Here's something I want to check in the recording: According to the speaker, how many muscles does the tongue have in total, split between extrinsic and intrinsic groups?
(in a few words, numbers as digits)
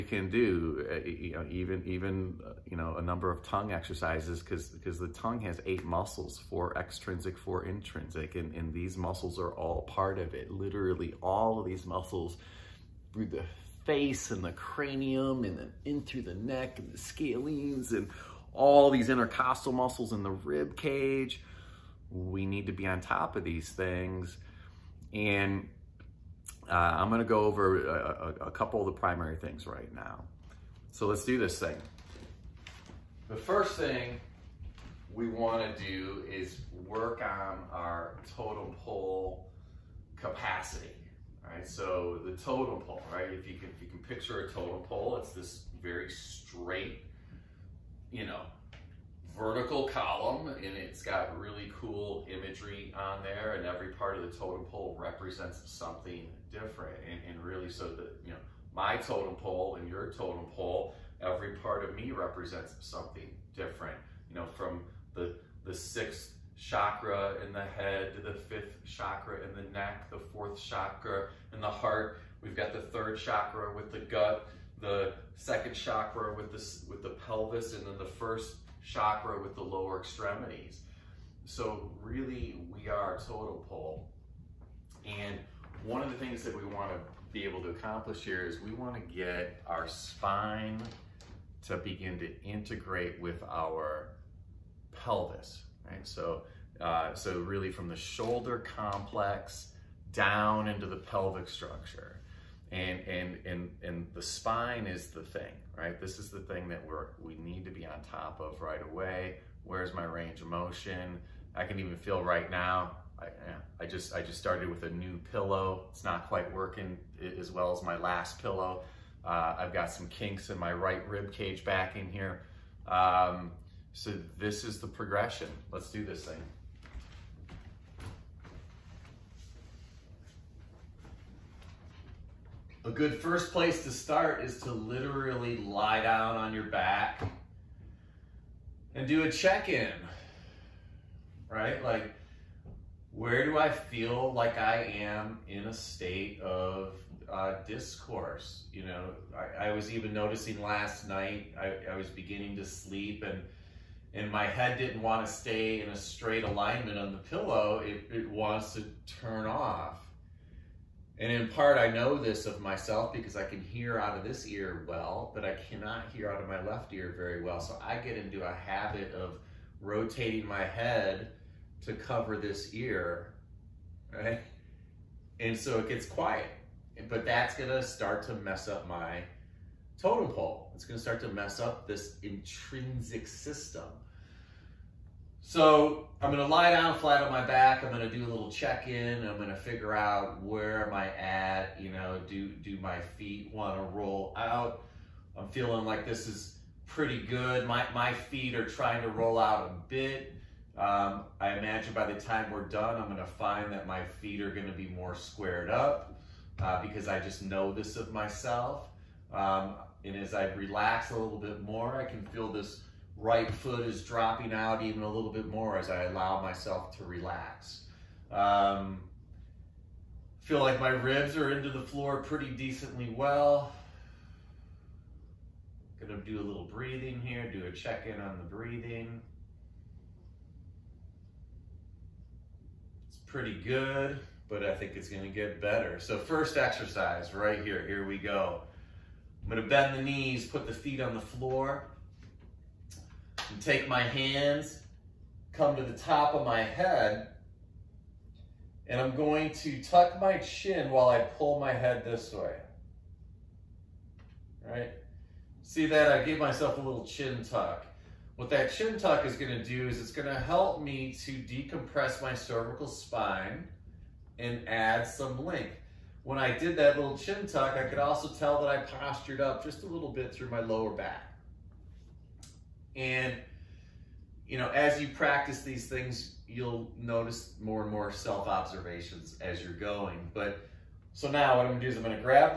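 8.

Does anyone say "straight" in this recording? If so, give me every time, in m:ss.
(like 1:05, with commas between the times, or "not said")
0:46, 2:35.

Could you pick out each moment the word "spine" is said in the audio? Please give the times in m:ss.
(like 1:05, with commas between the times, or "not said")
1:29, 1:44, 4:22.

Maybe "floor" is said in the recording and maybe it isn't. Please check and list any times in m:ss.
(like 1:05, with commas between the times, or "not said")
3:41, 4:01.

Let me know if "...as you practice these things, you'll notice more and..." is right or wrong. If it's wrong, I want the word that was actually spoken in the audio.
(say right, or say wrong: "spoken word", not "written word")
right.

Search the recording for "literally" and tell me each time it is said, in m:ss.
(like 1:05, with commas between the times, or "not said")
0:10, 2:14.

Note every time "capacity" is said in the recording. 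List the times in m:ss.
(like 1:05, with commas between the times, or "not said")
0:40.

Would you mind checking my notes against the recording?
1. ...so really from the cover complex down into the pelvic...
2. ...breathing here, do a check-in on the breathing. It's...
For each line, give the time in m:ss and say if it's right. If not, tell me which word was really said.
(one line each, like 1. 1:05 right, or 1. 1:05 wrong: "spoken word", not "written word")
1. 1:37 wrong: "shoulder", not "cover"
2. 3:46 right.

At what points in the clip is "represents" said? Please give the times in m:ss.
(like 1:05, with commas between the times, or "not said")
0:54, 1:02.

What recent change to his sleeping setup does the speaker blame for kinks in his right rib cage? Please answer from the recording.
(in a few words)
a new pillow.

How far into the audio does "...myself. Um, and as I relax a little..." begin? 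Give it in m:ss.
3:28.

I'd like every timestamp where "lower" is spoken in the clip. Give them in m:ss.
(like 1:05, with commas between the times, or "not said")
1:19, 4:30.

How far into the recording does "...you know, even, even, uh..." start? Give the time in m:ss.
0:01.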